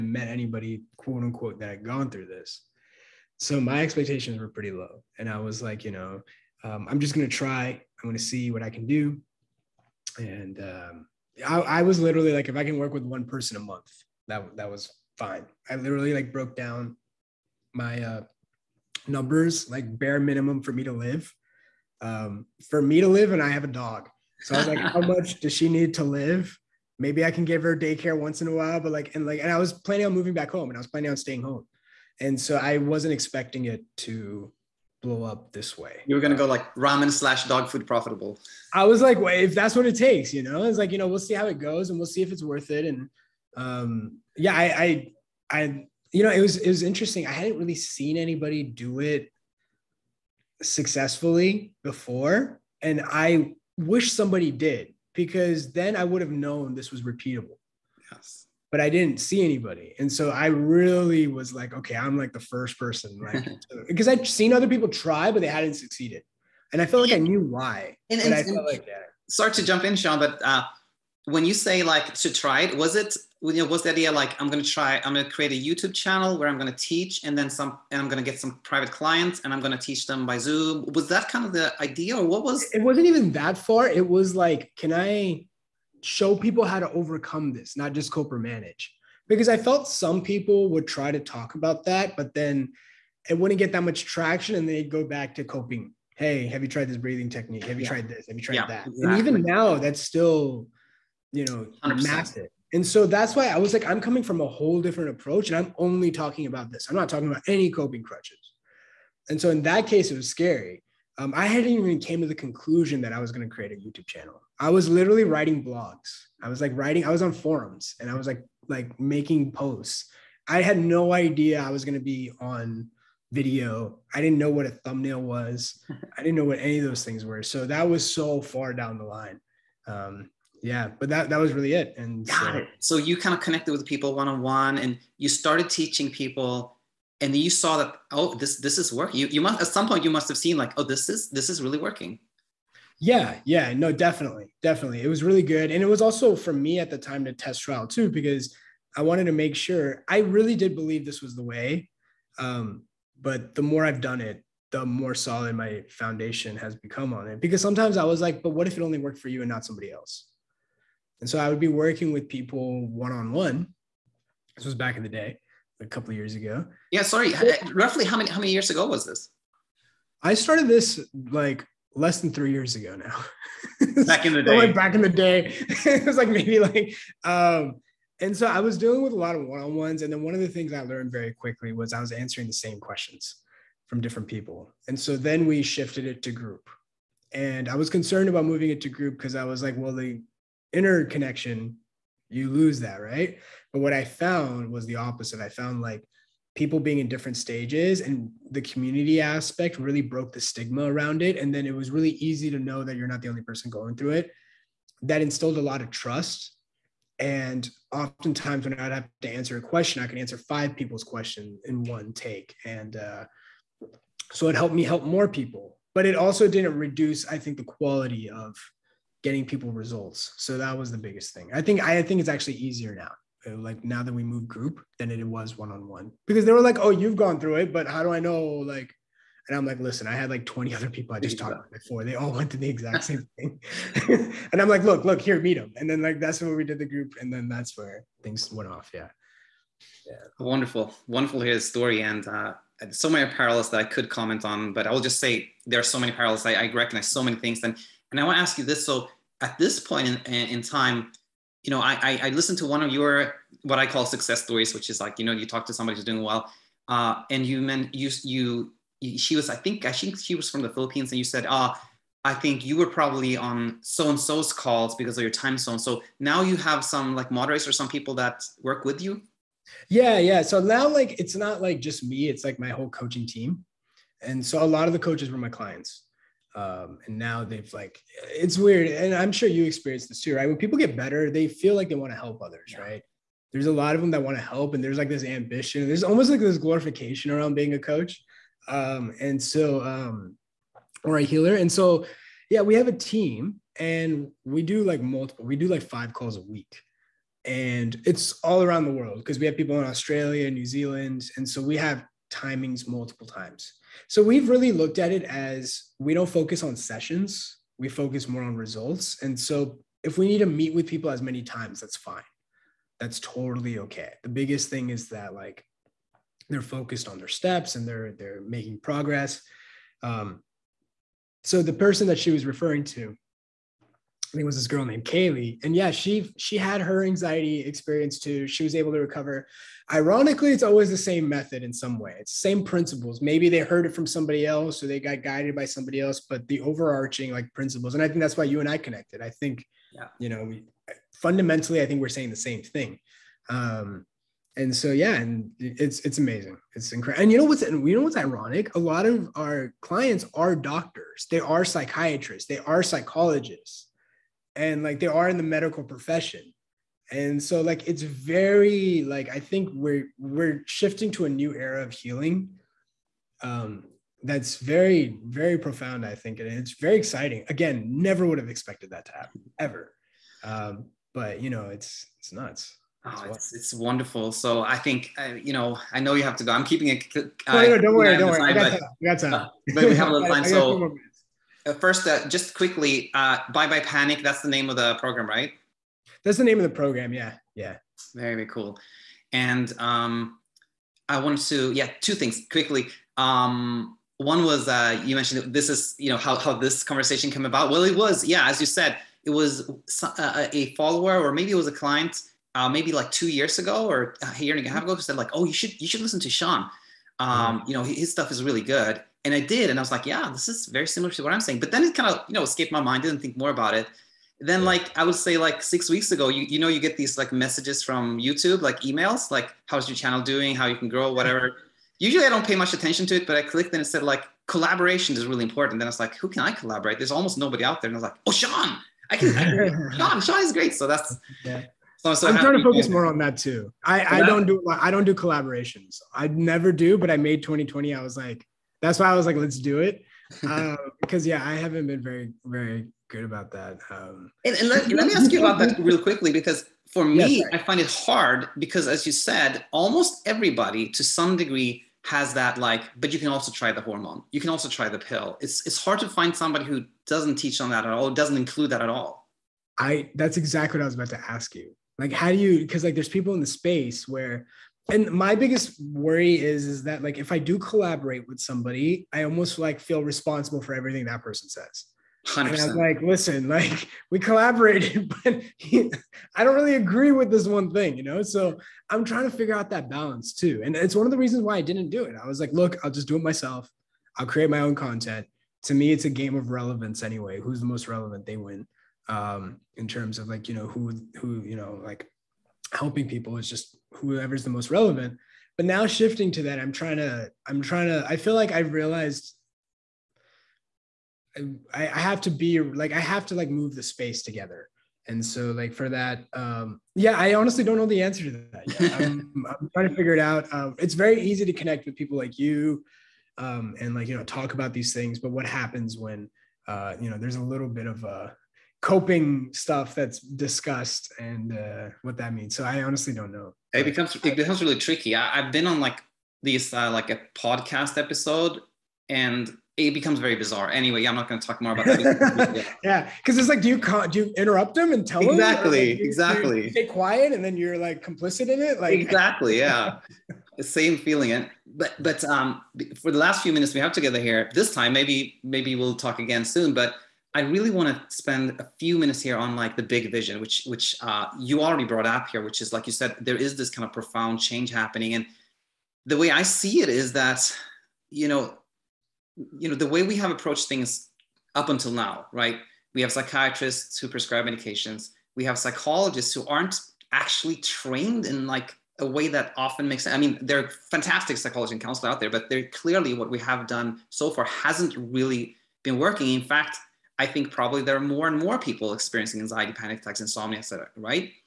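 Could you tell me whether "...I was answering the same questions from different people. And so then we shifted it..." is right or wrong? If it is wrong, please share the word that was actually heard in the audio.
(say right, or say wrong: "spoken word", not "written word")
right.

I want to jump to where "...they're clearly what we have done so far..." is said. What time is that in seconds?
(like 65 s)
572 s.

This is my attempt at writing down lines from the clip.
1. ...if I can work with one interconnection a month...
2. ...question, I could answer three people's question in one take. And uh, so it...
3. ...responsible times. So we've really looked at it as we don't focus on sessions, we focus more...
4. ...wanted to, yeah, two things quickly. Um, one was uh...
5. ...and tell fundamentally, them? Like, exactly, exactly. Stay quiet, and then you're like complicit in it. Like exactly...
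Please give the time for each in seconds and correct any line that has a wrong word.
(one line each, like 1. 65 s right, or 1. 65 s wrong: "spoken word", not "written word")
1. 12 s wrong: "person", not "interconnection"
2. 209 s wrong: "five", not "three"
3. 302 s wrong: "multiple", not "responsible"
4. 391 s right
5. 534 s wrong: "exactly", not "fundamentally".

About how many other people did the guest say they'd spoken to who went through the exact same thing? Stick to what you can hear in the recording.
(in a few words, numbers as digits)
20.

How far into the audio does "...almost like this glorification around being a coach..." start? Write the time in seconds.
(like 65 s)
286 s.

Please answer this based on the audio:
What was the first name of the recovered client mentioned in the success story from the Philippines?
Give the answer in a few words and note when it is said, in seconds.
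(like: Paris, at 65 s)
Kaylee, at 325 s.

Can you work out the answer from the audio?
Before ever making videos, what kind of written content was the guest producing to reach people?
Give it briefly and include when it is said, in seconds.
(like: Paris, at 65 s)
blogs, at 115 s.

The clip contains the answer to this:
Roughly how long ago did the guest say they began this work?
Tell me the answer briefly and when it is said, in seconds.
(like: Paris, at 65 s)
less than 3 years, at 171 s.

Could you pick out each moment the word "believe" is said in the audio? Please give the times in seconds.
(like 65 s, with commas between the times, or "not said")
150 s.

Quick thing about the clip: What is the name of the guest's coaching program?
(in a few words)
Bye Bye Panic.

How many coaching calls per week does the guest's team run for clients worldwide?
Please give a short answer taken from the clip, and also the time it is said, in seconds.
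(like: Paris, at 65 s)
5, at 295 s.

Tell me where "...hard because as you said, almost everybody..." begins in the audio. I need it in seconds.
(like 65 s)
447 s.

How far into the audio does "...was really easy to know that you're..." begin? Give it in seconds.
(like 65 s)
201 s.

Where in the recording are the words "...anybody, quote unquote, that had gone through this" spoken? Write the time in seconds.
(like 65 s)
0 s.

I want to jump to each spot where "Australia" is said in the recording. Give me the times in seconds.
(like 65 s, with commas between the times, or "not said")
299 s.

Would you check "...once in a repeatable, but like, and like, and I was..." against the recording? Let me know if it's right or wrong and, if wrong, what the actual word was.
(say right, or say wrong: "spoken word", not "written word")
wrong: "while", not "repeatable".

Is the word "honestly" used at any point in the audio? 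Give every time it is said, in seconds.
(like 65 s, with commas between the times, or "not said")
507 s, 522 s.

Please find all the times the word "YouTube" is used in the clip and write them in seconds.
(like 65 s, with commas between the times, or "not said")
75 s, 113 s, 418 s.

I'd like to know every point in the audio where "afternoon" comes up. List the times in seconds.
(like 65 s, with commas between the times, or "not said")
not said.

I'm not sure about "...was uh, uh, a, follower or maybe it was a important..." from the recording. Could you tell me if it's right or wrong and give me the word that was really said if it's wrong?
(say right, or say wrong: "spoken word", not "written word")
wrong: "client", not "important".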